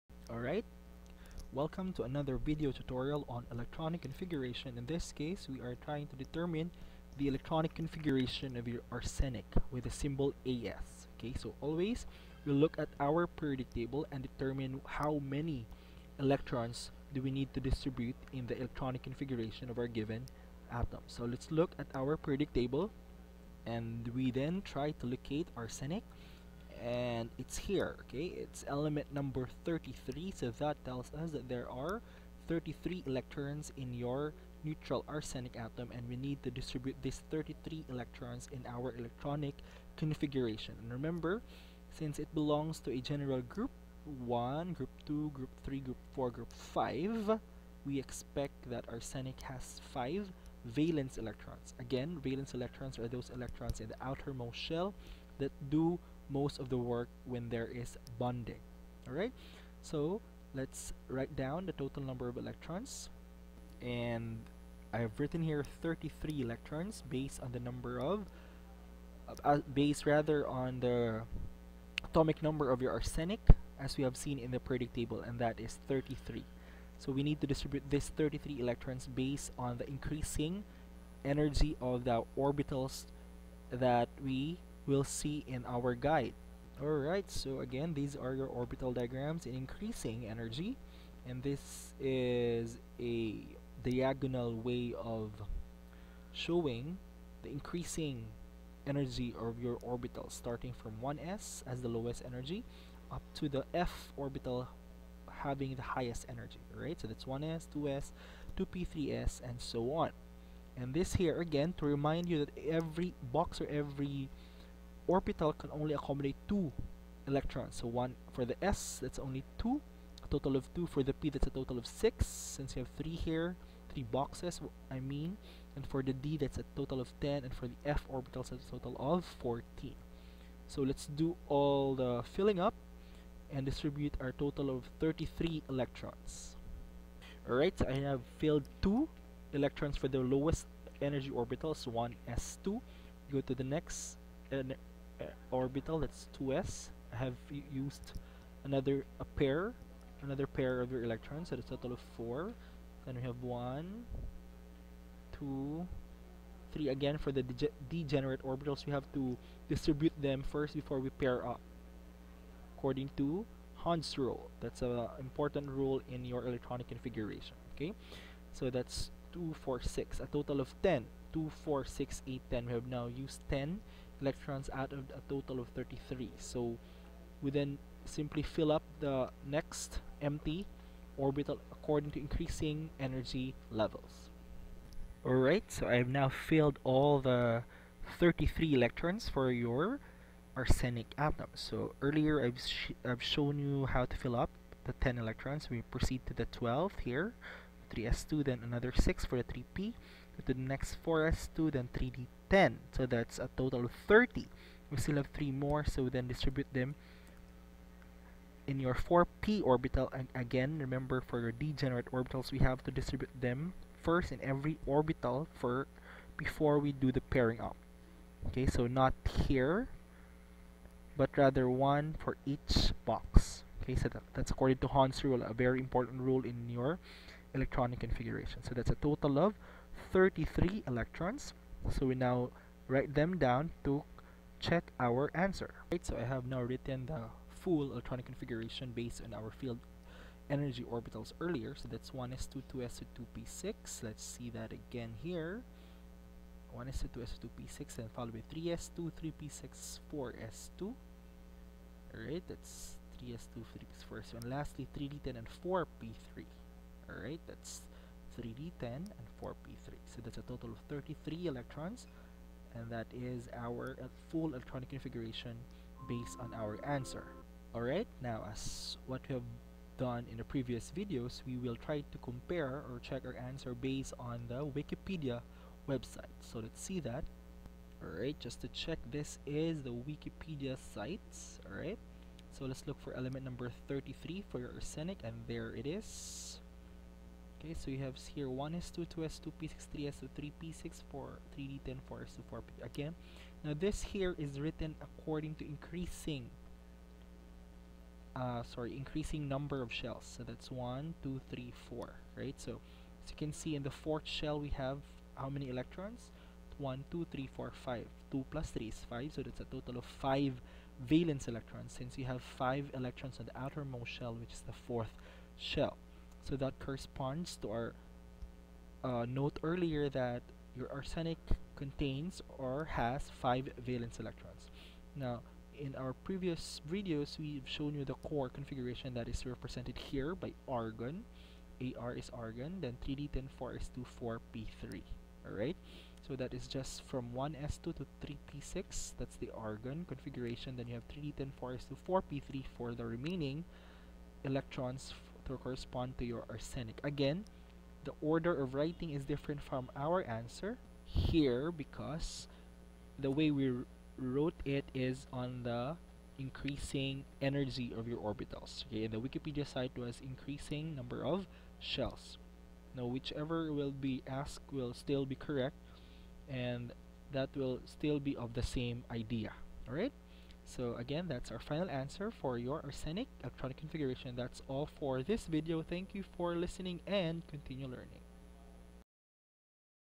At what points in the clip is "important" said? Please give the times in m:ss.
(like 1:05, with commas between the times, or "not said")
2:45, 3:45.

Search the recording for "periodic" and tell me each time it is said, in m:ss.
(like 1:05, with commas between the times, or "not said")
0:13, 0:22, 1:14.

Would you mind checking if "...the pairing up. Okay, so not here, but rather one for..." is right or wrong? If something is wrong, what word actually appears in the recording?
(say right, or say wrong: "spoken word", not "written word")
right.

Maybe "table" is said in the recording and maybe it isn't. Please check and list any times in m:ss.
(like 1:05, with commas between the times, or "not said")
0:13, 0:22, 1:14.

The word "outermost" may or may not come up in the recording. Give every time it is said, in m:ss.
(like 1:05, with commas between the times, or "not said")
0:54, 5:13.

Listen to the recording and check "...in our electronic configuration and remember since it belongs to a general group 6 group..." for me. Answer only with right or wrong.
wrong.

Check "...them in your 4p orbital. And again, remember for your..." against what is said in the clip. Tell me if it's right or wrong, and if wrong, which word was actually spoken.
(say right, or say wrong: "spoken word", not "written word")
right.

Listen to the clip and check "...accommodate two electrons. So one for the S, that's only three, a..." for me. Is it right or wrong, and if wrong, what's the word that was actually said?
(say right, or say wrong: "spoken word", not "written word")
wrong: "two", not "three".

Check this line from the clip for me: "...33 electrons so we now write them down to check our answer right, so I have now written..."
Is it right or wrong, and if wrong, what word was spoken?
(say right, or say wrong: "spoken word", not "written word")
right.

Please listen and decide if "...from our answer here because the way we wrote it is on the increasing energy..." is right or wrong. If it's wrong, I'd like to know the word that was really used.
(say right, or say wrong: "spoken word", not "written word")
right.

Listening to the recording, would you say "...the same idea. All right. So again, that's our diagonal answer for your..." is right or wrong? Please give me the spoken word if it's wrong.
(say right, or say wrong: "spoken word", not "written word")
wrong: "final", not "diagonal".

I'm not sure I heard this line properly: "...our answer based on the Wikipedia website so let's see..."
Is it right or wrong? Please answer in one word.
right.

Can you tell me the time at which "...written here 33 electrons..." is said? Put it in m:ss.
1:05.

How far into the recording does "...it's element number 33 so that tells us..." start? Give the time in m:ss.
0:28.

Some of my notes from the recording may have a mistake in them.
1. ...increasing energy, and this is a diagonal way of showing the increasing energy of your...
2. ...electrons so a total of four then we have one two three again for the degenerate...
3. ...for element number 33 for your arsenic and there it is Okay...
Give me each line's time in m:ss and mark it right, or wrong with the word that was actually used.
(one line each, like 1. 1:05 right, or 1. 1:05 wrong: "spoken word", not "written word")
1. 1:29 right
2. 2:31 right
3. 4:43 right.